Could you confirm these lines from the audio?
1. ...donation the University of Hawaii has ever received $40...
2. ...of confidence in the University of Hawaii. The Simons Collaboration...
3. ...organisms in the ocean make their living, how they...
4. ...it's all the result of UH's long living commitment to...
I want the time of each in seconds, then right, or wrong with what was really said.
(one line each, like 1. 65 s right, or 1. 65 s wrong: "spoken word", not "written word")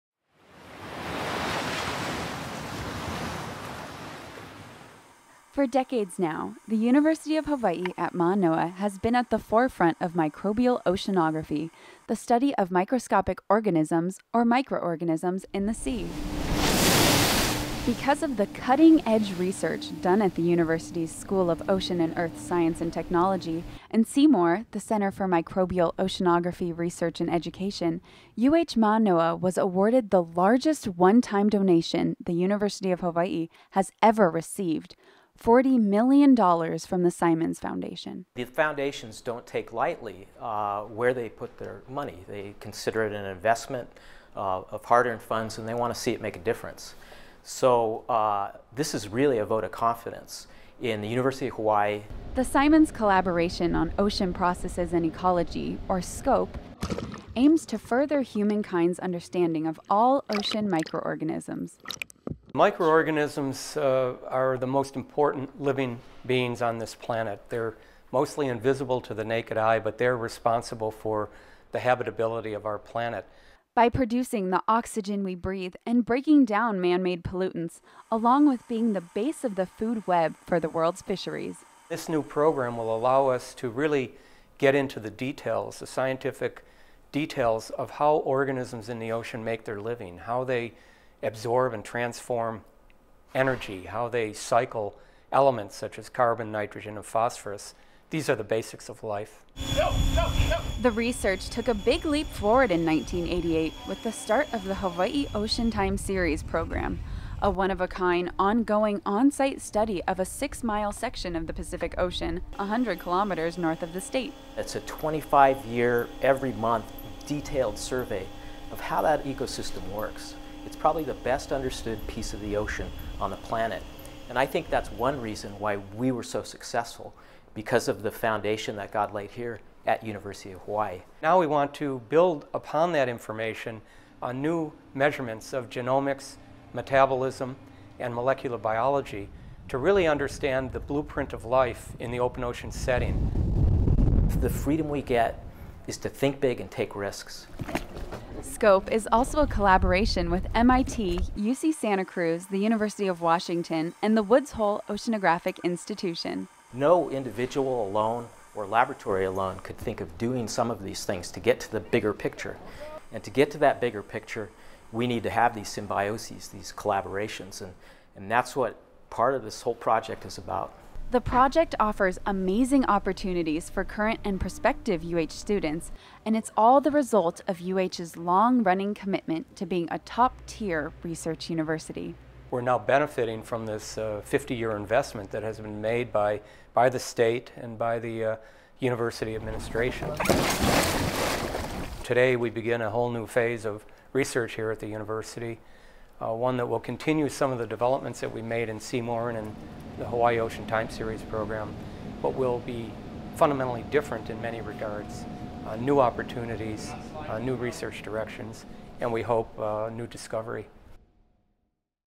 1. 31 s right
2. 49 s right
3. 88 s right
4. 176 s wrong: "running", not "living".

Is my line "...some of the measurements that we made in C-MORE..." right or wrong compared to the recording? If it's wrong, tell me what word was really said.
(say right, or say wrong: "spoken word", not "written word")
wrong: "developments", not "measurements".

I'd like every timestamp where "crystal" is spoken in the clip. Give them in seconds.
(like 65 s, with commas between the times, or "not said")
not said.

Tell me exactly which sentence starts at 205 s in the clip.
Uh, new opportunities, uh, new research directions, and we hope uh, new discovery.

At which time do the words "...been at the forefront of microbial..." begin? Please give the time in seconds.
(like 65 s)
8 s.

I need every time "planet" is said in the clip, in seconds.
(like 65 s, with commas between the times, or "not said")
66 s, 72 s, 123 s.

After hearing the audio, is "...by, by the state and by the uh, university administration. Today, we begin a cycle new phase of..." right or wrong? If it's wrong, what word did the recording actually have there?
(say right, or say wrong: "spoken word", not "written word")
wrong: "whole", not "cycle".